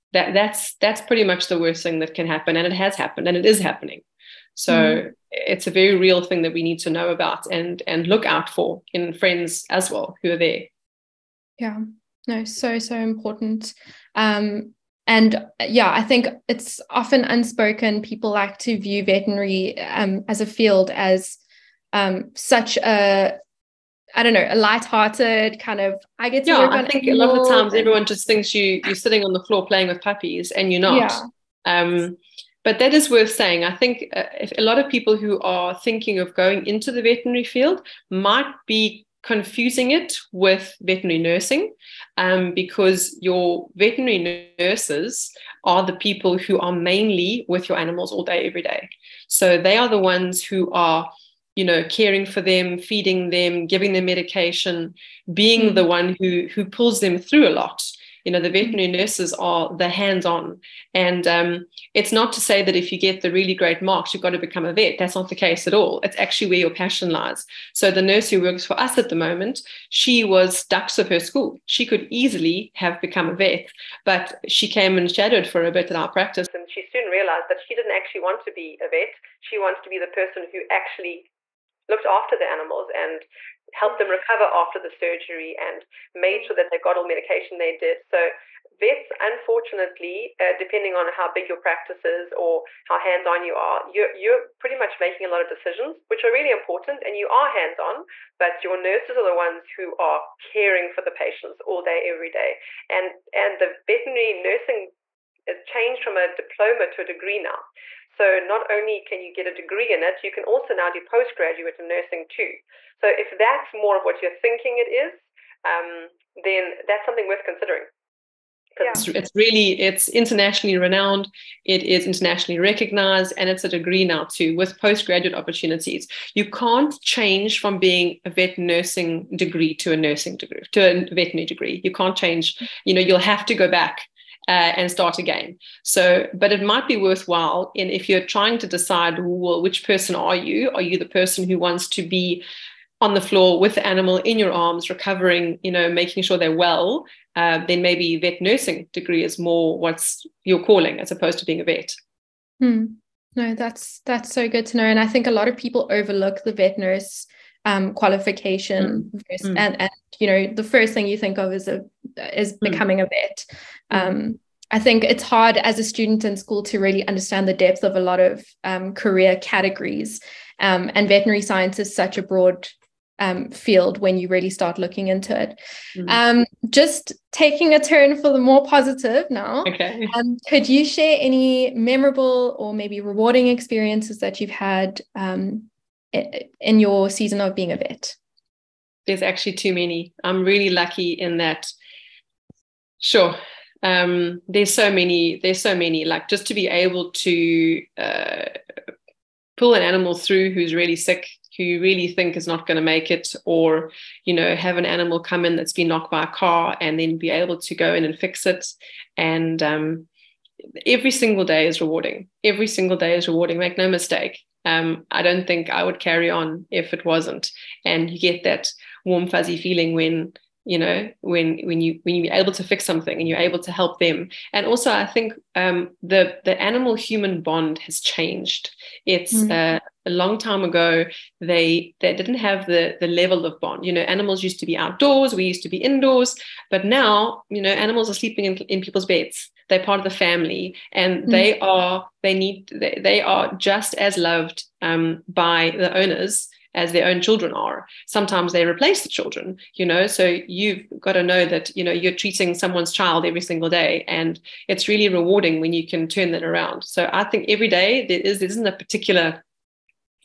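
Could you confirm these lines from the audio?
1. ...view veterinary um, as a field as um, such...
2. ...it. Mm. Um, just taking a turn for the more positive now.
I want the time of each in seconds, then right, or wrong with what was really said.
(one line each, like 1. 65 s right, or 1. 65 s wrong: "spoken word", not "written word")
1. 18 s right
2. 175 s right.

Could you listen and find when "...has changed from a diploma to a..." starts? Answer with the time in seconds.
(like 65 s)
105 s.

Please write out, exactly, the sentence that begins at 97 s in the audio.
And you are hands-on, but your nurses are the ones who are caring for the patients all day, every day.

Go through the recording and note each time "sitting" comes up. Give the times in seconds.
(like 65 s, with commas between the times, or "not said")
28 s.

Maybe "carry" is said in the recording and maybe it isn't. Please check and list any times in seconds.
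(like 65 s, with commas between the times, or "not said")
216 s.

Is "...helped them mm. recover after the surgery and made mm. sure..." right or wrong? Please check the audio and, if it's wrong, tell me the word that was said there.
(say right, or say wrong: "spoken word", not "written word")
right.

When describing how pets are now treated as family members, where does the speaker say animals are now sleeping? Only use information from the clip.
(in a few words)
In people's beds.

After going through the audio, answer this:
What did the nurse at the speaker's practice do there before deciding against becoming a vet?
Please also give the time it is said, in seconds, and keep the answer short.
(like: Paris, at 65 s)
Shadowed, at 75 s.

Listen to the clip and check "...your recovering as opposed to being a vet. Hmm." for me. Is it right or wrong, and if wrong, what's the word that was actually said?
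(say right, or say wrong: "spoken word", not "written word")
wrong: "calling", not "recovering".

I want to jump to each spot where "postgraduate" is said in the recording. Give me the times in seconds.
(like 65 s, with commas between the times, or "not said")
111 s, 124 s.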